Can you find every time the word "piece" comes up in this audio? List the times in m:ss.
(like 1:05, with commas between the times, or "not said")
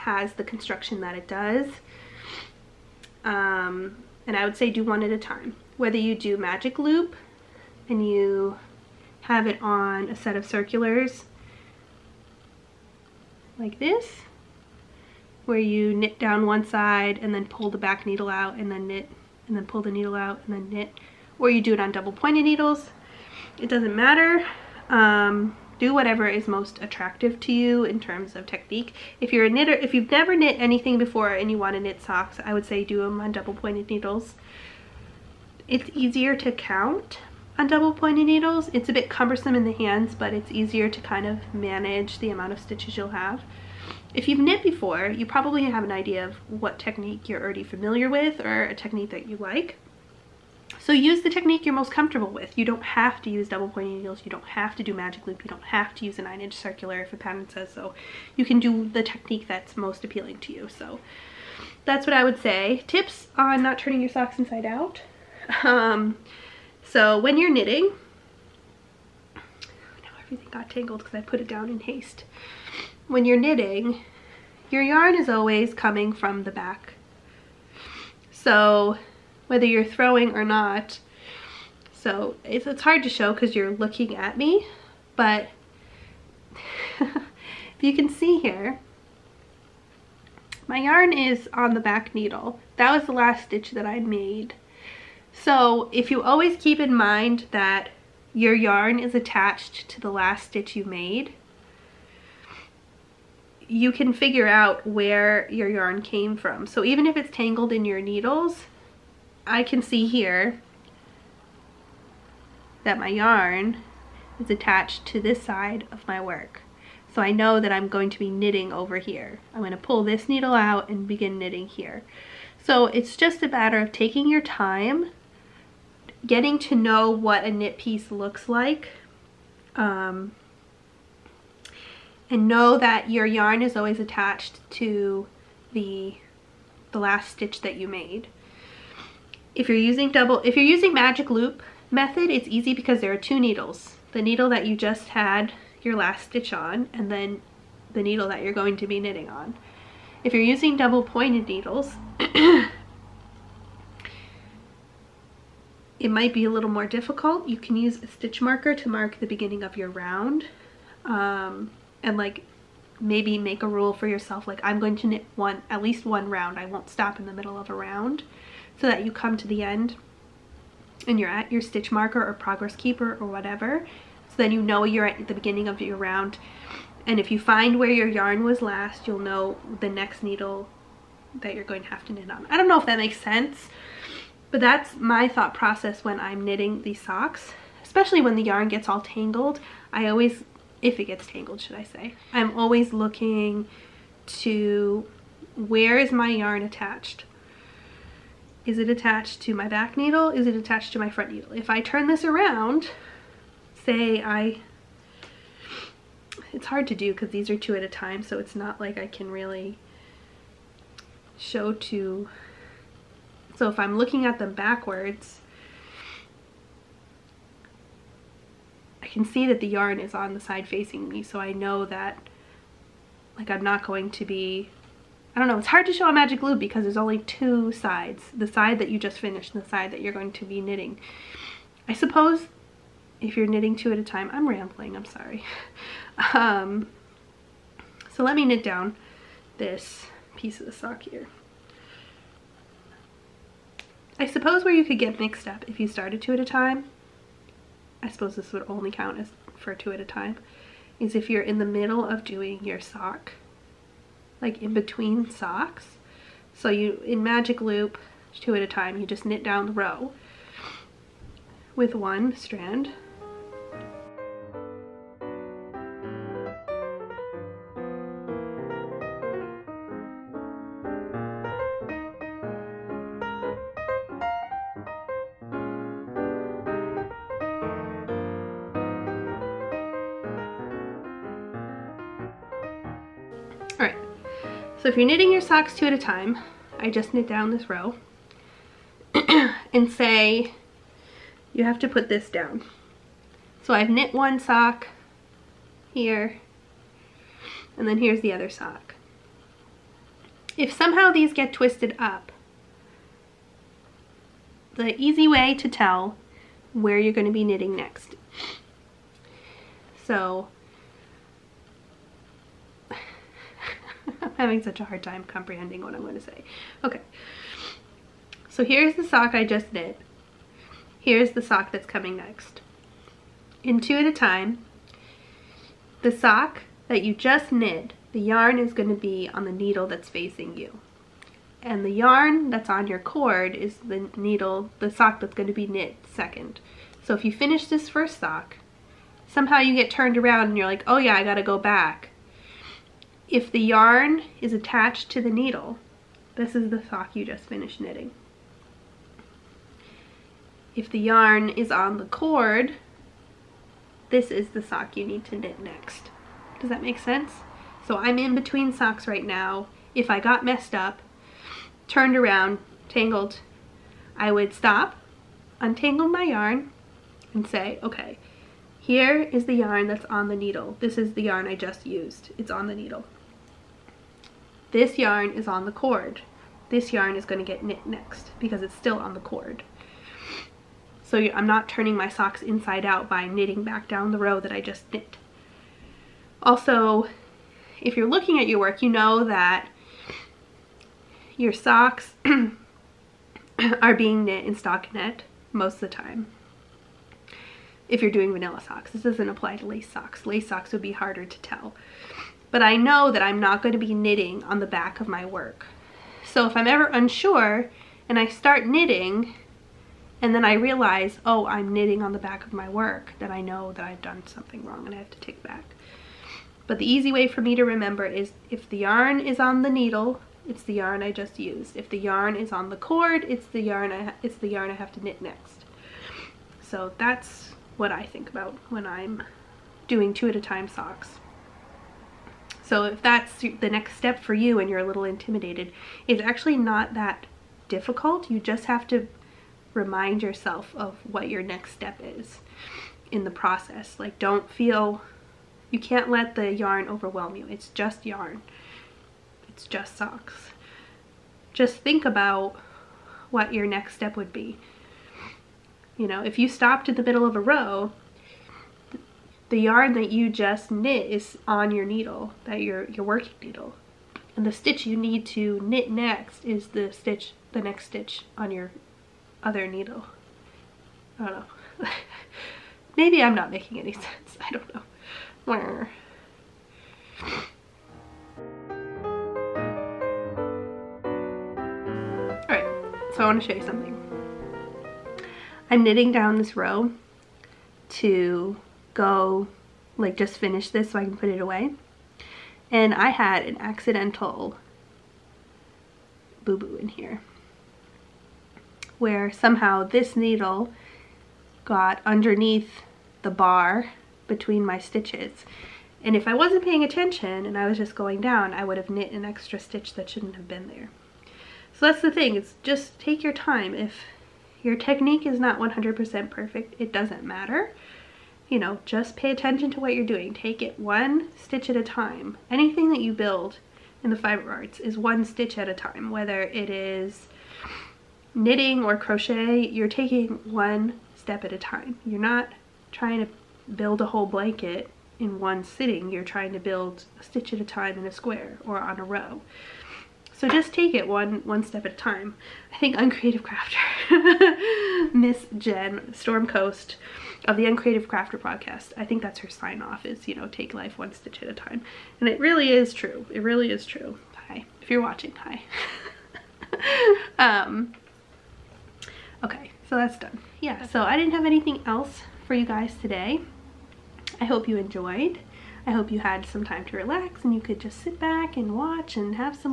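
2:07, 4:00.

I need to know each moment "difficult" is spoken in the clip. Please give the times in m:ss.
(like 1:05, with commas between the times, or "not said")
2:36, 7:17.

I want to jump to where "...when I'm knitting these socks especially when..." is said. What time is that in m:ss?
3:06.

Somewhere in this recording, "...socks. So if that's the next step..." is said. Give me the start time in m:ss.
7:10.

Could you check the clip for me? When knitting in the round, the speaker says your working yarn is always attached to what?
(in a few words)
the last stitch you made.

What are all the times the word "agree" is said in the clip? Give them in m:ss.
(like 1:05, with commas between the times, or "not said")
not said.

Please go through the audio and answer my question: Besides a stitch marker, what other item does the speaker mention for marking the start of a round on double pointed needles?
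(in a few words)
progress keeper.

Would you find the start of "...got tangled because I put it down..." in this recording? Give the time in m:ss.
1:10.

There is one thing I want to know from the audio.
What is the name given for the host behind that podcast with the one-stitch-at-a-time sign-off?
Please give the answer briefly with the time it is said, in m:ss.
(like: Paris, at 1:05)
Jen, at 9:05.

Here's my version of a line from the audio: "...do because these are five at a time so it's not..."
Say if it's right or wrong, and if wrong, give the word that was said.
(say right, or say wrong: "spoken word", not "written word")
wrong: "two", not "five".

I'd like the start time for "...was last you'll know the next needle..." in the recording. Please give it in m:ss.
2:58.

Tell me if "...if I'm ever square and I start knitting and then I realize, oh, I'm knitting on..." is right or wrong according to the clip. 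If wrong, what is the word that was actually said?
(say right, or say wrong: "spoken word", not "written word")
wrong: "unsure", not "square".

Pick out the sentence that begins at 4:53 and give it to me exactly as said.
So I've knit one sock here, and then here's the other sock.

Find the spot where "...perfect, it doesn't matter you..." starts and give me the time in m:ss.
8:36.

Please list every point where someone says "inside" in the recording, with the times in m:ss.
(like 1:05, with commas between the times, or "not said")
1:04, 6:22.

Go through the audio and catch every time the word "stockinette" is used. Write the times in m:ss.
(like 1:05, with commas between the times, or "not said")
6:34.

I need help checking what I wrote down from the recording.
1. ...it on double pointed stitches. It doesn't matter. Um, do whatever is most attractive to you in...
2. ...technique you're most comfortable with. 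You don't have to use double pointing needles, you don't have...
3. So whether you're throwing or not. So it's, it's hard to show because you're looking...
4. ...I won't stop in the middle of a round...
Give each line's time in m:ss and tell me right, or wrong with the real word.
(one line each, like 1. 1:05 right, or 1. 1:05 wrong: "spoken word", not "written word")
1. 0:21 wrong: "needles", not "stitches"
2. 0:51 right
3. 1:18 right
4. 2:46 right.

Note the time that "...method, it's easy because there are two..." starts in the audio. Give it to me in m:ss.
2:21.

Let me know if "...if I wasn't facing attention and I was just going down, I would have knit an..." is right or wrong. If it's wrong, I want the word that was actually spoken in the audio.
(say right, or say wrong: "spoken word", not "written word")
wrong: "paying", not "facing".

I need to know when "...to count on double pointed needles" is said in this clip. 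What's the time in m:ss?
0:36.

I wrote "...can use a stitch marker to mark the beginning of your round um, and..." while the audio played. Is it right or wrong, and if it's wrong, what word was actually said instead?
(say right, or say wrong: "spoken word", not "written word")
right.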